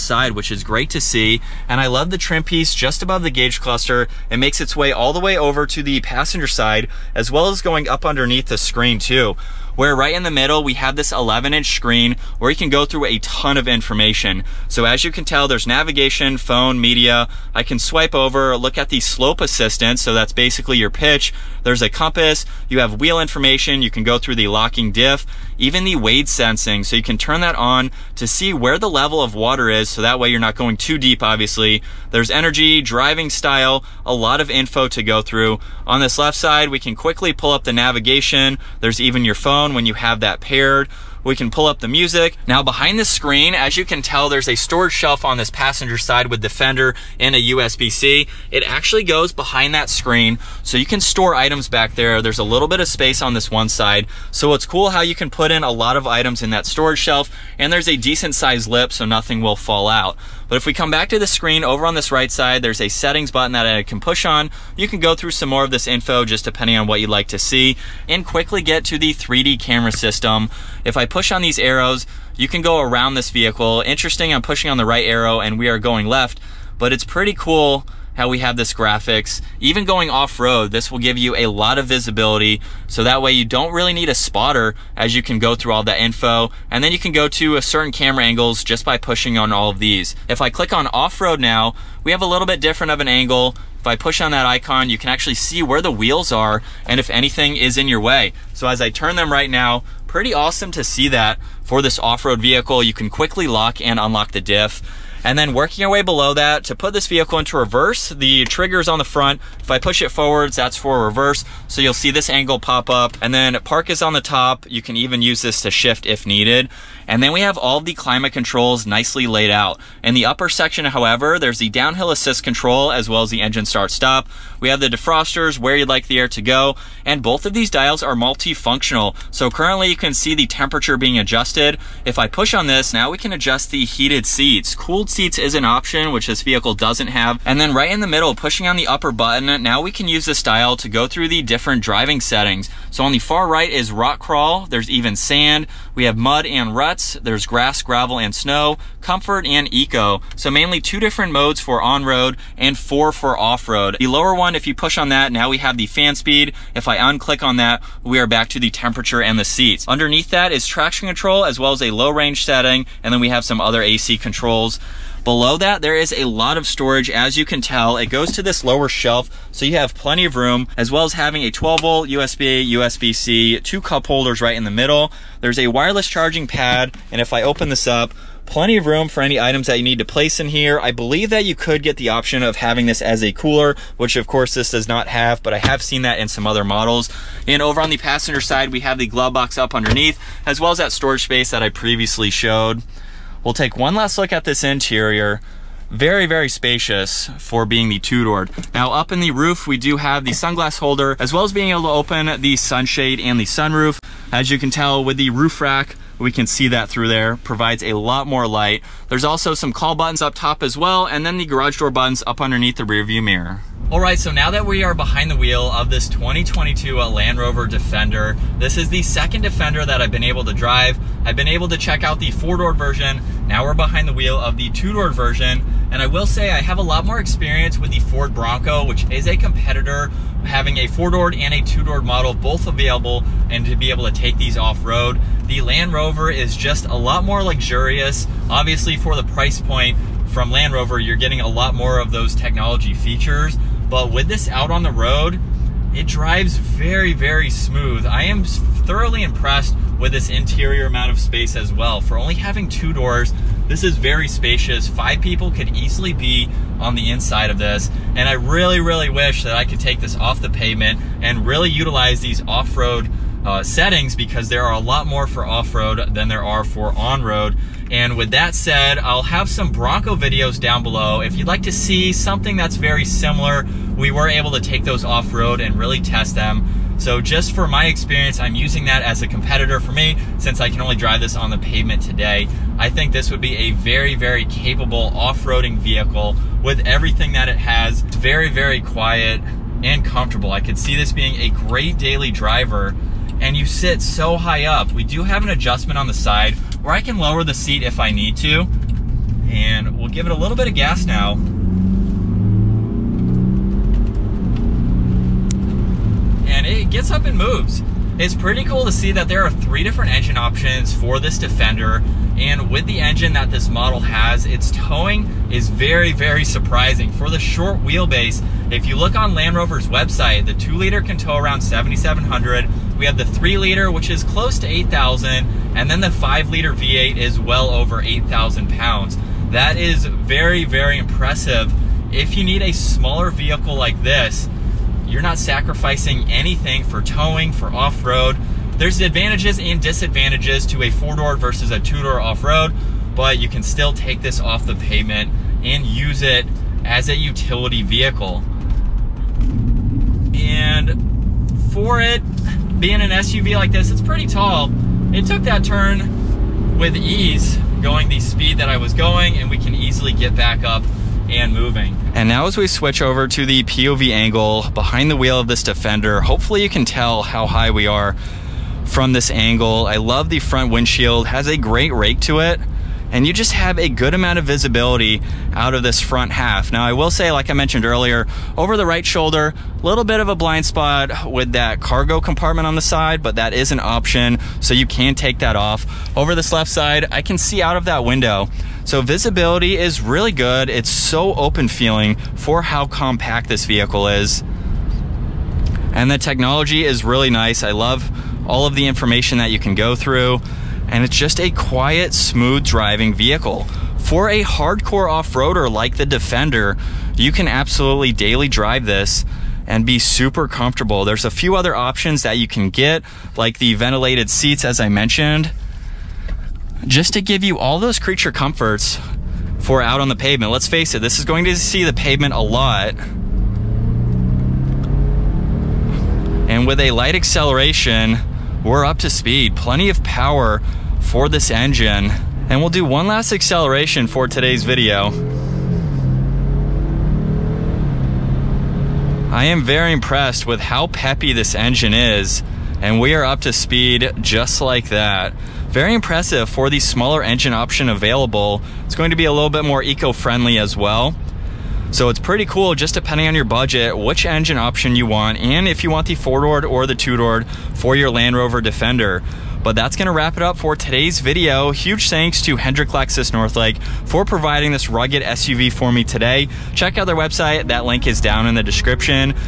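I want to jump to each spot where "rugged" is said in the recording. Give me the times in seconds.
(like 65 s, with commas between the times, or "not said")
464 s.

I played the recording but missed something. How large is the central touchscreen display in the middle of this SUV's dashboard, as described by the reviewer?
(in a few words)
11 inch.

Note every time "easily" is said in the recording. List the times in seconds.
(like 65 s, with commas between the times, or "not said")
255 s, 359 s.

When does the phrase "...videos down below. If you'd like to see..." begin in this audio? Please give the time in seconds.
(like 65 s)
270 s.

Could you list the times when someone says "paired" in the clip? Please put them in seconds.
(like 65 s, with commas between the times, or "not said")
40 s.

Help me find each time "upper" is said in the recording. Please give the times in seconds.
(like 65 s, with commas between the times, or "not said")
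120 s, 138 s.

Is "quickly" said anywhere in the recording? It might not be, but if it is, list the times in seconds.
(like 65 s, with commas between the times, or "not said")
36 s, 68 s, 103 s.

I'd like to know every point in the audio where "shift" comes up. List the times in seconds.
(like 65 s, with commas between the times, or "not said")
115 s.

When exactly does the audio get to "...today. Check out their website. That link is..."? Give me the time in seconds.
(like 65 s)
466 s.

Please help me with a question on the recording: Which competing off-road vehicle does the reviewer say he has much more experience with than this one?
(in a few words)
Ford Bronco.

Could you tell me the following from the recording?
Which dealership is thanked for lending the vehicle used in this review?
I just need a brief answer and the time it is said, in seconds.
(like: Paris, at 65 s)
Hendrick Lexus Northlake, at 462 s.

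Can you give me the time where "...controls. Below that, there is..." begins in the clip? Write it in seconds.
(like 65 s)
164 s.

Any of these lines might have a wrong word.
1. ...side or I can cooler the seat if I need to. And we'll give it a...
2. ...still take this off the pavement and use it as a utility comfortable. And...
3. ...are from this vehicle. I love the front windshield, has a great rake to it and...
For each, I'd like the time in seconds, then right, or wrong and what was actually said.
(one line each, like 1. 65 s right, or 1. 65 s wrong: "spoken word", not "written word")
1. 296 s wrong: "lower", not "cooler"
2. 343 s wrong: "vehicle", not "comfortable"
3. 367 s wrong: "angle", not "vehicle".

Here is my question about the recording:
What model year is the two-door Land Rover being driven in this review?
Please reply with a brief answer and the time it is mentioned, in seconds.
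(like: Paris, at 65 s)
2022, at 216 s.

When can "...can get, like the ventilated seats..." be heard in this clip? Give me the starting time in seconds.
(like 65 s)
412 s.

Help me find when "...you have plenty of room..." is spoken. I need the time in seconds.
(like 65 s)
169 s.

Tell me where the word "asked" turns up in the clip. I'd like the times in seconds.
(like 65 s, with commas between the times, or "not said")
not said.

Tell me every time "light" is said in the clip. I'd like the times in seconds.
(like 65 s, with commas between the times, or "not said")
208 s, 426 s.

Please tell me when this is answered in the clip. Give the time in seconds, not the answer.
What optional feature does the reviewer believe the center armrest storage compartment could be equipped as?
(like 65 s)
183 s.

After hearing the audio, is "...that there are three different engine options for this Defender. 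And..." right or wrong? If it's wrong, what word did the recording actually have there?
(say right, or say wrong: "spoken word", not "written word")
right.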